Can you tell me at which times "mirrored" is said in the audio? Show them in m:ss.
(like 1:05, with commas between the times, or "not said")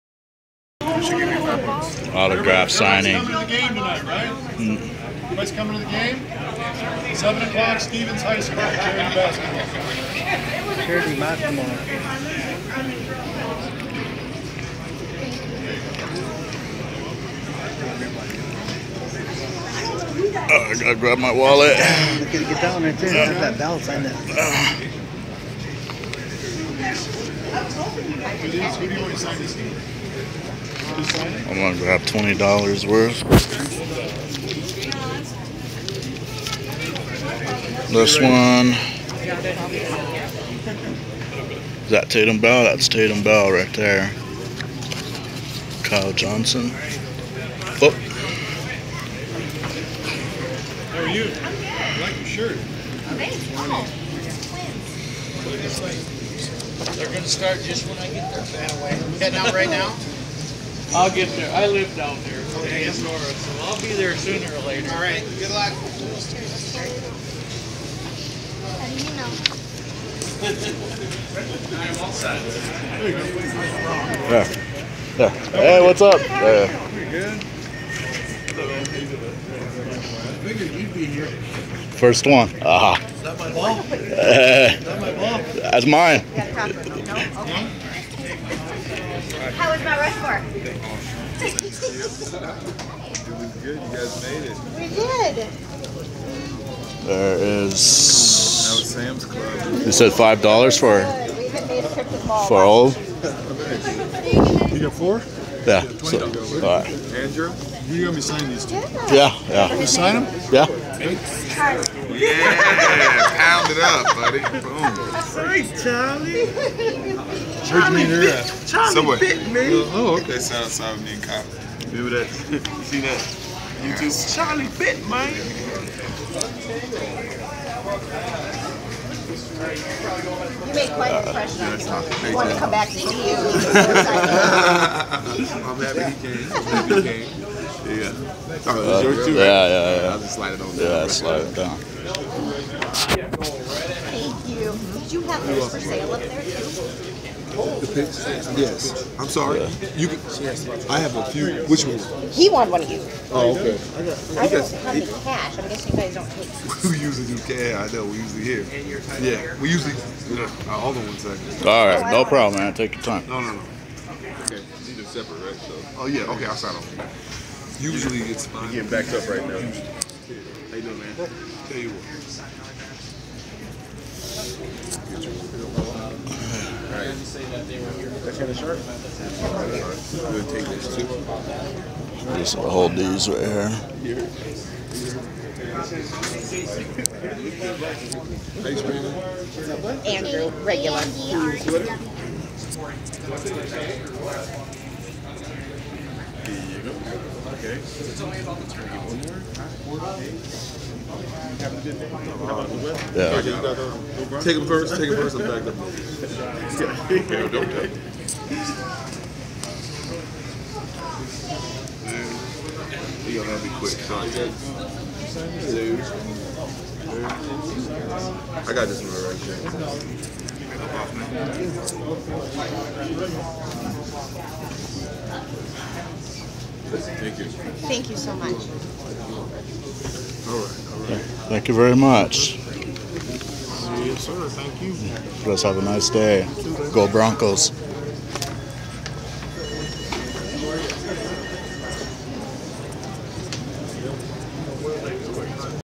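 not said.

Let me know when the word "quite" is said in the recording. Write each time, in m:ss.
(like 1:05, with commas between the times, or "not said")
2:10.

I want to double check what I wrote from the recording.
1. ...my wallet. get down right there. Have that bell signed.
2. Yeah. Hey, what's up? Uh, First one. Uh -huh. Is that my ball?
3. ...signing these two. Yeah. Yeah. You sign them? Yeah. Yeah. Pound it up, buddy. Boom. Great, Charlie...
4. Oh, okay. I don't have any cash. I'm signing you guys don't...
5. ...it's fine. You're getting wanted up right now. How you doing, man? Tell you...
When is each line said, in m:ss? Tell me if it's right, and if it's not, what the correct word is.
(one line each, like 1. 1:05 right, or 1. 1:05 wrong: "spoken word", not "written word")
1. 0:21 right
2. 1:15 right
3. 1:48 right
4. 2:33 wrong: "guessing", not "signing"
5. 2:48 wrong: "backed", not "wanted".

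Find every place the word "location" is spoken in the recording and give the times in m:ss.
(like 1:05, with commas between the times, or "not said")
not said.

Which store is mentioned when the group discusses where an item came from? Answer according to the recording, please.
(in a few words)
Sam's Club.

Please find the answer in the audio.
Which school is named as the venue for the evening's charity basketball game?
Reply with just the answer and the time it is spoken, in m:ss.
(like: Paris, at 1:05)
Stevens High School, at 0:07.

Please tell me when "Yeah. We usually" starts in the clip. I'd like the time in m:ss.
2:39.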